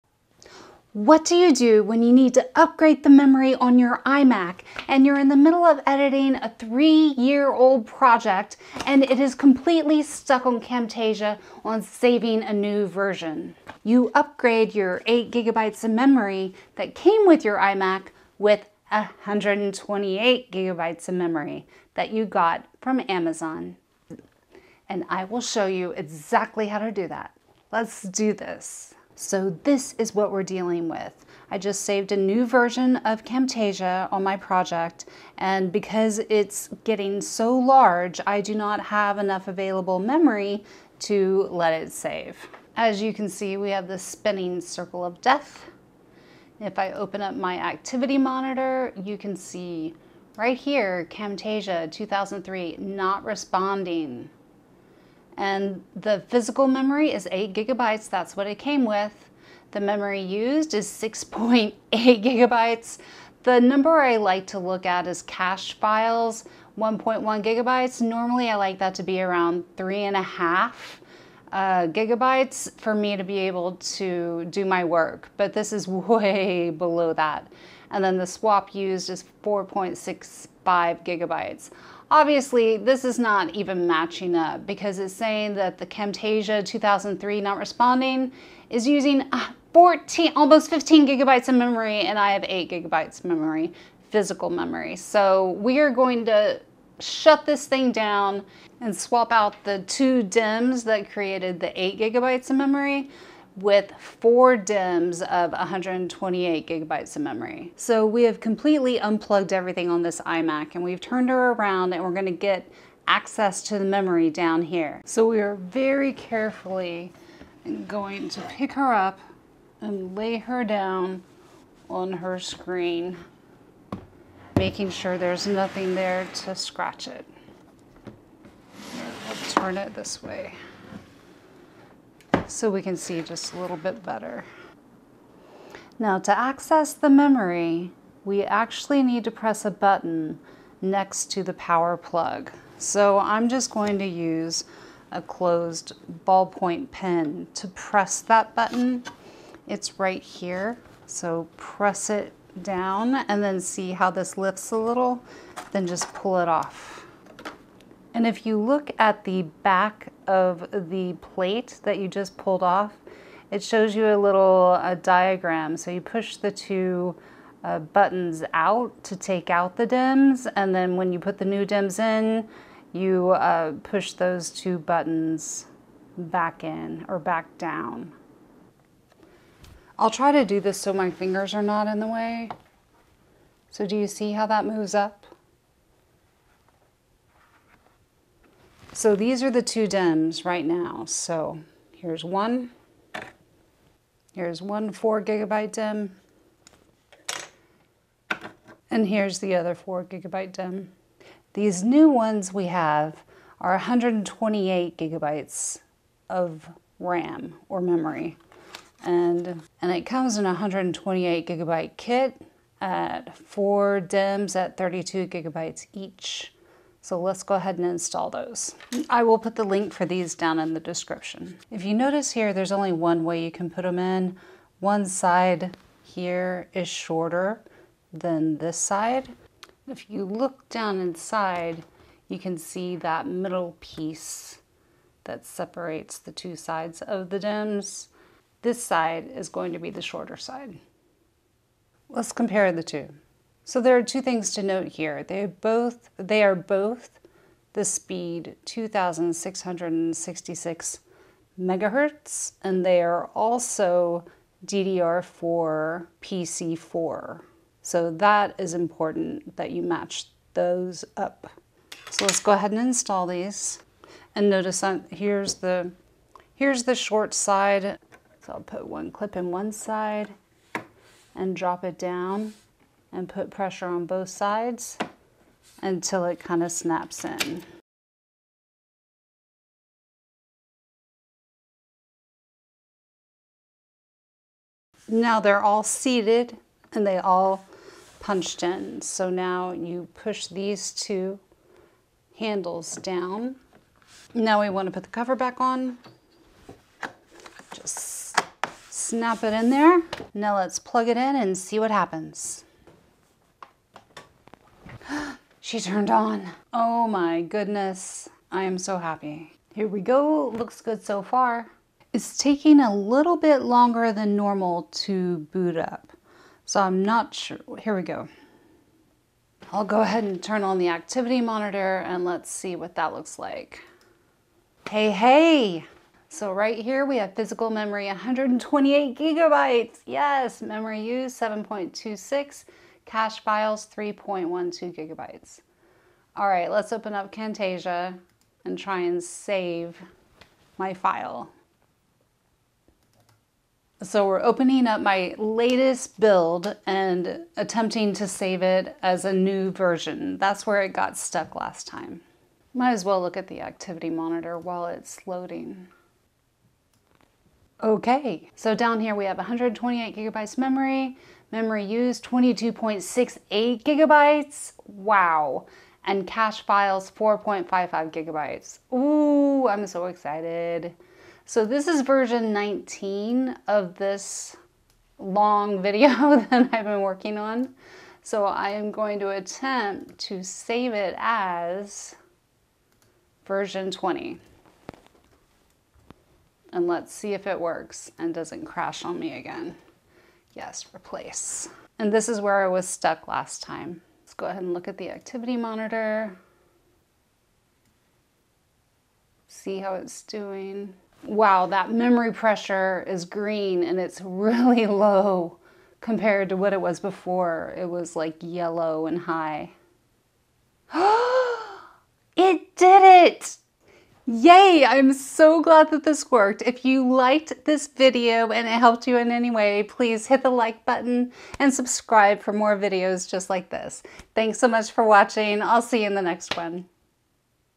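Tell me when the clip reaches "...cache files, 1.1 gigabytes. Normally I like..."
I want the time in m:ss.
1:05.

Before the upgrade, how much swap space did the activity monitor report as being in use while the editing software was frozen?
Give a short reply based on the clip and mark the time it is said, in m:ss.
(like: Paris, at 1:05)
4.65 gigabytes, at 1:19.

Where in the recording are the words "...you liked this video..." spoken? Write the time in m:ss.
6:56.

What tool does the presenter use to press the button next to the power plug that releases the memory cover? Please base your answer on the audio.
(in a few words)
closed ballpoint pen.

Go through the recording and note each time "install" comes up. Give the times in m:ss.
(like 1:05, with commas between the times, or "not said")
3:37, 4:22.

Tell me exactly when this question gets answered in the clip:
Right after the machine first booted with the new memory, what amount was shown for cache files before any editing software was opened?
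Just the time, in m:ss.
5:33.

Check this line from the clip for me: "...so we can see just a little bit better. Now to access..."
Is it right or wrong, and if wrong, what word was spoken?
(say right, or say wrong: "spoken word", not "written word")
right.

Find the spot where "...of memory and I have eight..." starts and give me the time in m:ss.
1:31.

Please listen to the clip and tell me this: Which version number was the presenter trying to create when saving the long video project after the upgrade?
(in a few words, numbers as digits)
20.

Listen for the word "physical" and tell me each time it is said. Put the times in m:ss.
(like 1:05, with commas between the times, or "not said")
0:56, 1:34, 5:27.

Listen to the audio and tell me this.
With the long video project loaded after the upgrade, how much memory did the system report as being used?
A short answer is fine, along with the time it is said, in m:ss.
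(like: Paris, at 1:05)
22.68 gigabytes, at 6:02.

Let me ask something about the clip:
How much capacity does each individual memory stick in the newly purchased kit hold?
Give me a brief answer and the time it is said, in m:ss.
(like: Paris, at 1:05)
32 gigabytes, at 3:34.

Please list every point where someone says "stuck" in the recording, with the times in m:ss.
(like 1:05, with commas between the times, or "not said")
0:10, 5:51, 6:32.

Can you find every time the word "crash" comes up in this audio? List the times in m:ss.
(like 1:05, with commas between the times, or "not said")
6:28.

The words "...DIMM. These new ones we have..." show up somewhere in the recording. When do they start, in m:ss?
3:20.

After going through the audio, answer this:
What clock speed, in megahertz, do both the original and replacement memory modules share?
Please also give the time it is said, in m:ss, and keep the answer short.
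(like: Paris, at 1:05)
2666 megahertz, at 4:08.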